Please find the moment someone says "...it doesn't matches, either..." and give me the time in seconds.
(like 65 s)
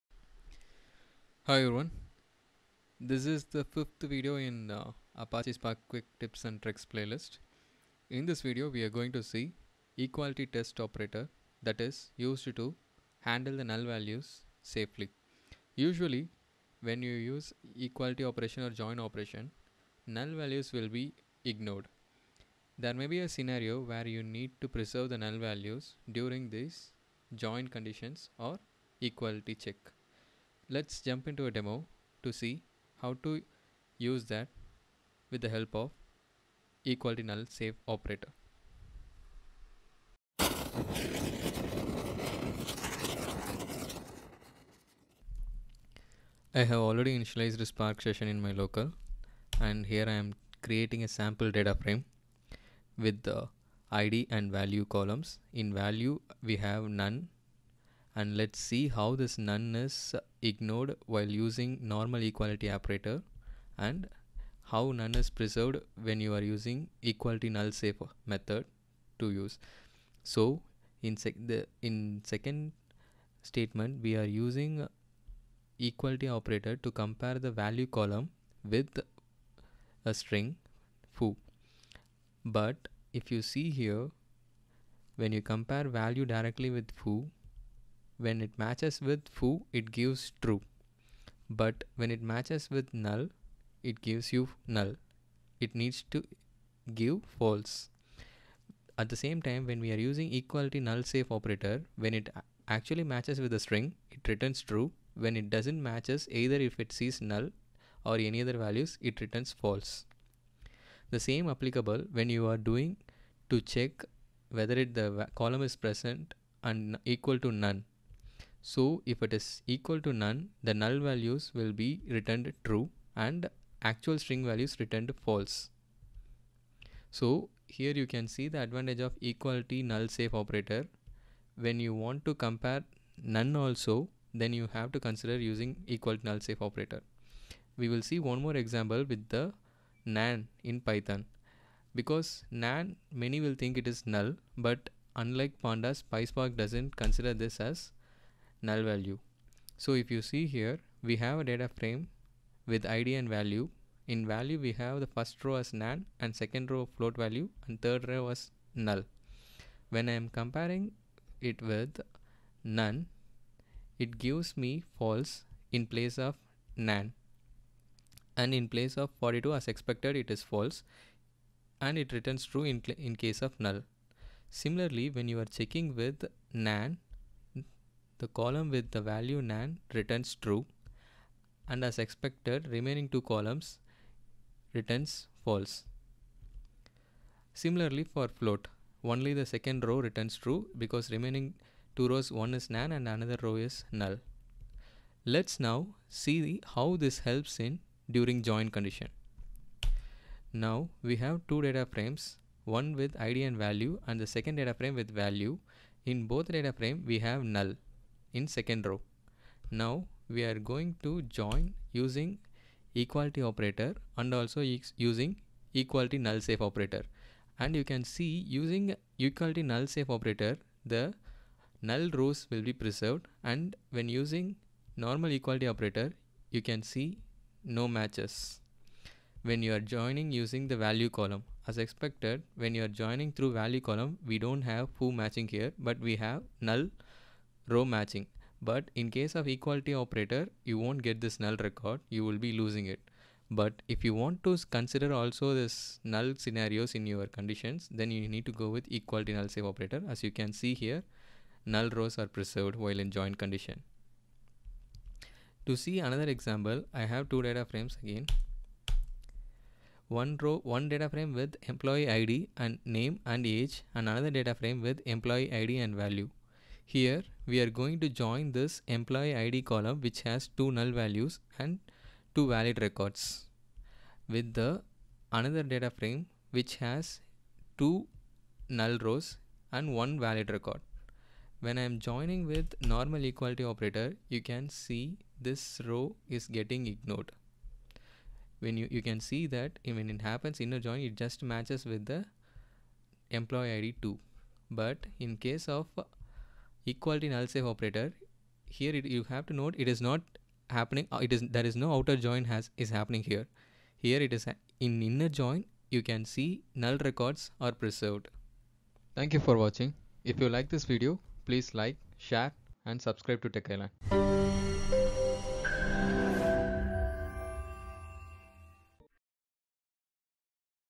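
105 s.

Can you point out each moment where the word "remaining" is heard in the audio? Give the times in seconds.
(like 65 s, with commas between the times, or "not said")
182 s, 191 s.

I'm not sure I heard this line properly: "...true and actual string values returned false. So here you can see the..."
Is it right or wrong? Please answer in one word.
right.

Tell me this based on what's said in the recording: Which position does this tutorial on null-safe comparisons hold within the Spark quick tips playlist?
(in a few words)
Fifth.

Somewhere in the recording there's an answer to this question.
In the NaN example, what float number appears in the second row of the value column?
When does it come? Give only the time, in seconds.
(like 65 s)
169 s.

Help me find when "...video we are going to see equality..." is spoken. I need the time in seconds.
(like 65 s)
8 s.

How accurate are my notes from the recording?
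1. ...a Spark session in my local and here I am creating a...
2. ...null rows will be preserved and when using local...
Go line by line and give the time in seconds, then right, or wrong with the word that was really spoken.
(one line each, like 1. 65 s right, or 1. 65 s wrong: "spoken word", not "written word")
1. 47 s right
2. 221 s wrong: "normal", not "local".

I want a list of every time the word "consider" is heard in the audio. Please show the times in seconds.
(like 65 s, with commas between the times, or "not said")
134 s, 146 s, 244 s.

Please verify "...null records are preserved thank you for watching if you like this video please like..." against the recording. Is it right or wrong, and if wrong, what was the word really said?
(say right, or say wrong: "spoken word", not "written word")
right.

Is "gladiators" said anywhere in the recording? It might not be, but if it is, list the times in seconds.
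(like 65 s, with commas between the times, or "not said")
not said.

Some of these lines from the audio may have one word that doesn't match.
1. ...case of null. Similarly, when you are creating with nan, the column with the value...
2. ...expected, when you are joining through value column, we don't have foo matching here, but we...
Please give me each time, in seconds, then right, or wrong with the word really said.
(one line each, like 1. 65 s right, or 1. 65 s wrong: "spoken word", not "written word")
1. 173 s wrong: "checking", not "creating"
2. 231 s right.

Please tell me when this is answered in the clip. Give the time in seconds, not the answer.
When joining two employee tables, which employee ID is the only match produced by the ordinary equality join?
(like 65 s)
293 s.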